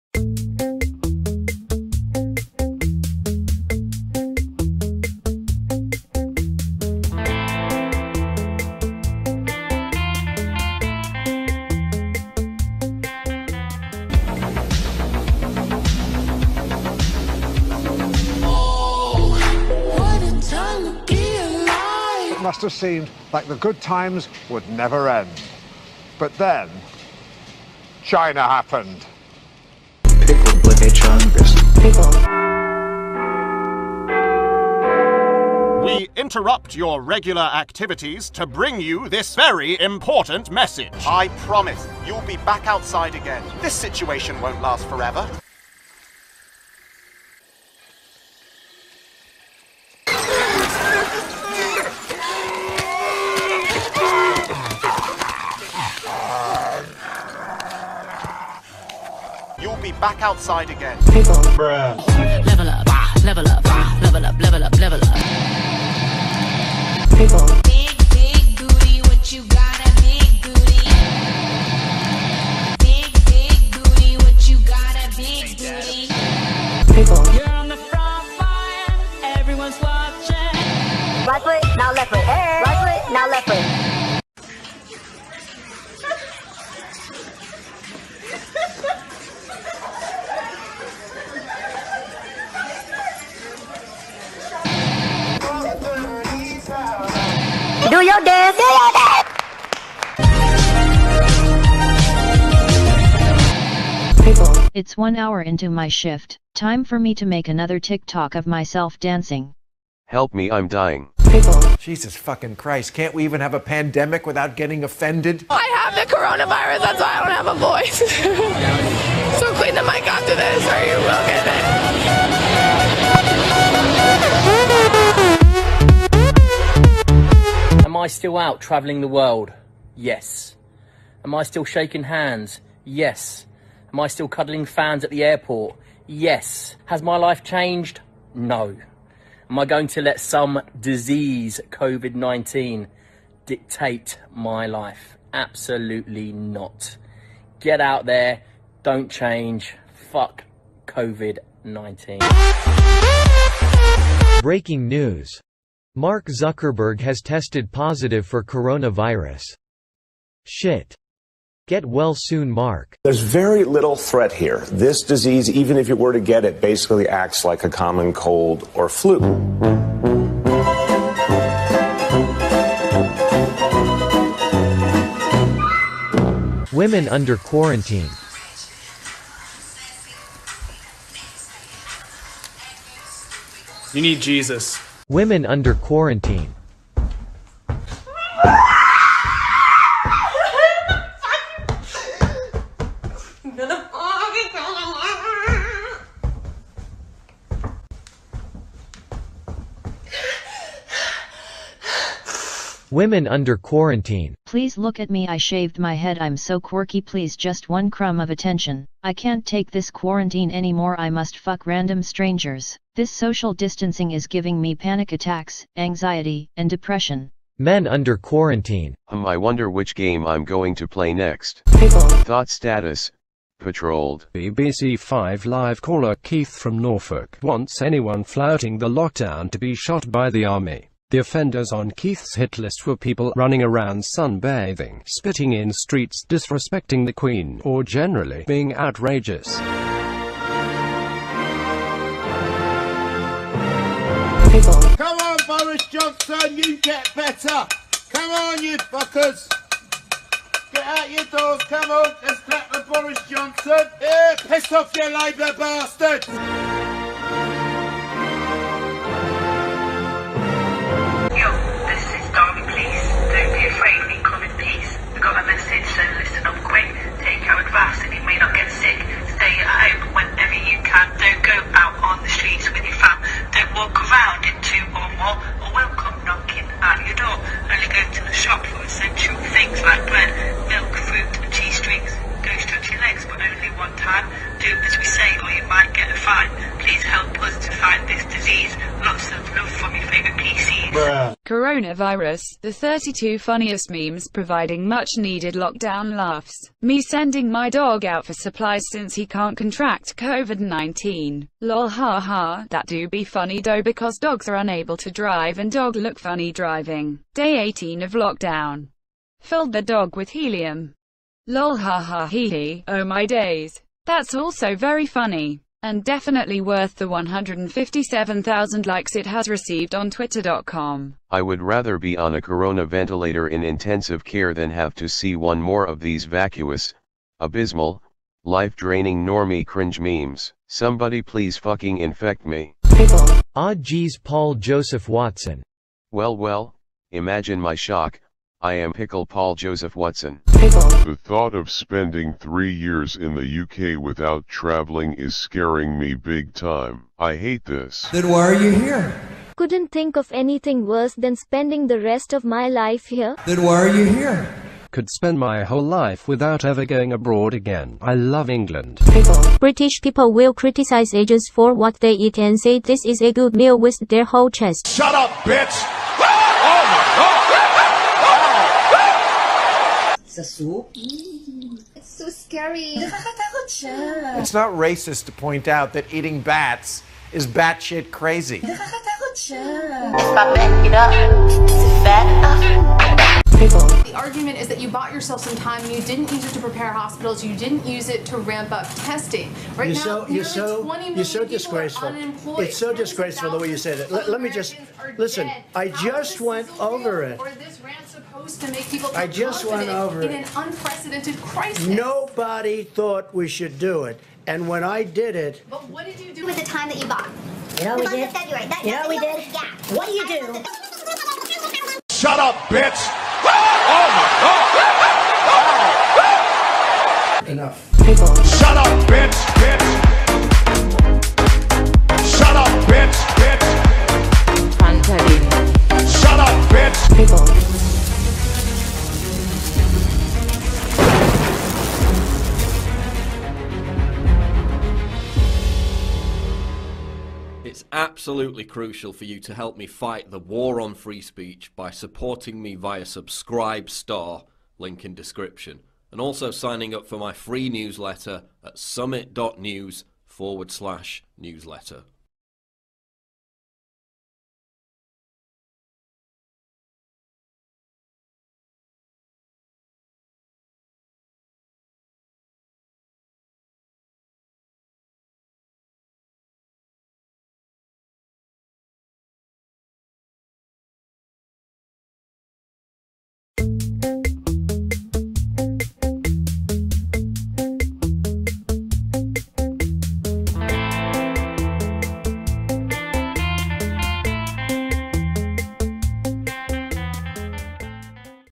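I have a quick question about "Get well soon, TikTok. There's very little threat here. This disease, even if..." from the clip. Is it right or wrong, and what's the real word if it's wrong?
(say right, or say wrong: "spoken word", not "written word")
wrong: "Mark", not "TikTok".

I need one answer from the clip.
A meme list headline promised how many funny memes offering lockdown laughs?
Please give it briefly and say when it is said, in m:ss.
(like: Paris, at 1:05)
32, at 4:52.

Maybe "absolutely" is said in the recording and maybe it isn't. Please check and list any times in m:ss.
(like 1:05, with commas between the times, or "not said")
2:25, 7:17.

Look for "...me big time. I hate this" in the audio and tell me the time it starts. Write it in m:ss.
5:45.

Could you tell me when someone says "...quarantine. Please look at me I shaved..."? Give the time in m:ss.
3:23.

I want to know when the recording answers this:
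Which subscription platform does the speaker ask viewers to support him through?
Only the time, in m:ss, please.
7:23.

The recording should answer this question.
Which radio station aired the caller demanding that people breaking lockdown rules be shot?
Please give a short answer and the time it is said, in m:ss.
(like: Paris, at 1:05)
BBC 5 Live, at 3:44.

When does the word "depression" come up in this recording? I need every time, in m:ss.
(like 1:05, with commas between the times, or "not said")
3:36.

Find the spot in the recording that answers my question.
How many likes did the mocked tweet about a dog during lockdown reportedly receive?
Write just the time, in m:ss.
5:17.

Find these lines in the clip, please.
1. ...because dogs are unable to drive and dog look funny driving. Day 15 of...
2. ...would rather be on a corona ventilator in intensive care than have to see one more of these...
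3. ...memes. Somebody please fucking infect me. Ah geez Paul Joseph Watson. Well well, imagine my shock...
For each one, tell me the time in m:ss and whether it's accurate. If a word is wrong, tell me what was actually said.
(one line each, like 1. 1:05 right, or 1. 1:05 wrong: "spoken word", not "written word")
1. 5:03 wrong: "18", not "15"
2. 5:21 right
3. 5:29 right.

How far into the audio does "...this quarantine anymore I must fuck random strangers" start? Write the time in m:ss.
3:29.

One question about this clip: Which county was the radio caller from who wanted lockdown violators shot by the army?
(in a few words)
Norfolk.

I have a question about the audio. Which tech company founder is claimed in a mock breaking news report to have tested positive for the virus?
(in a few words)
Mark Zuckerberg.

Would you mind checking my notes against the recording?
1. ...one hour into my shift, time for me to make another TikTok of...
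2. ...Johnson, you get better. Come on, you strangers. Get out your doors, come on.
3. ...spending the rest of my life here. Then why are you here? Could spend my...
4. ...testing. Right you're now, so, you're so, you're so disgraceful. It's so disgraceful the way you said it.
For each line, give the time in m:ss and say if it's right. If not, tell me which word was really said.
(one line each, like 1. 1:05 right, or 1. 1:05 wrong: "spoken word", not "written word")
1. 1:44 right
2. 4:05 wrong: "fuckers", not "strangers"
3. 5:51 right
4. 6:29 right.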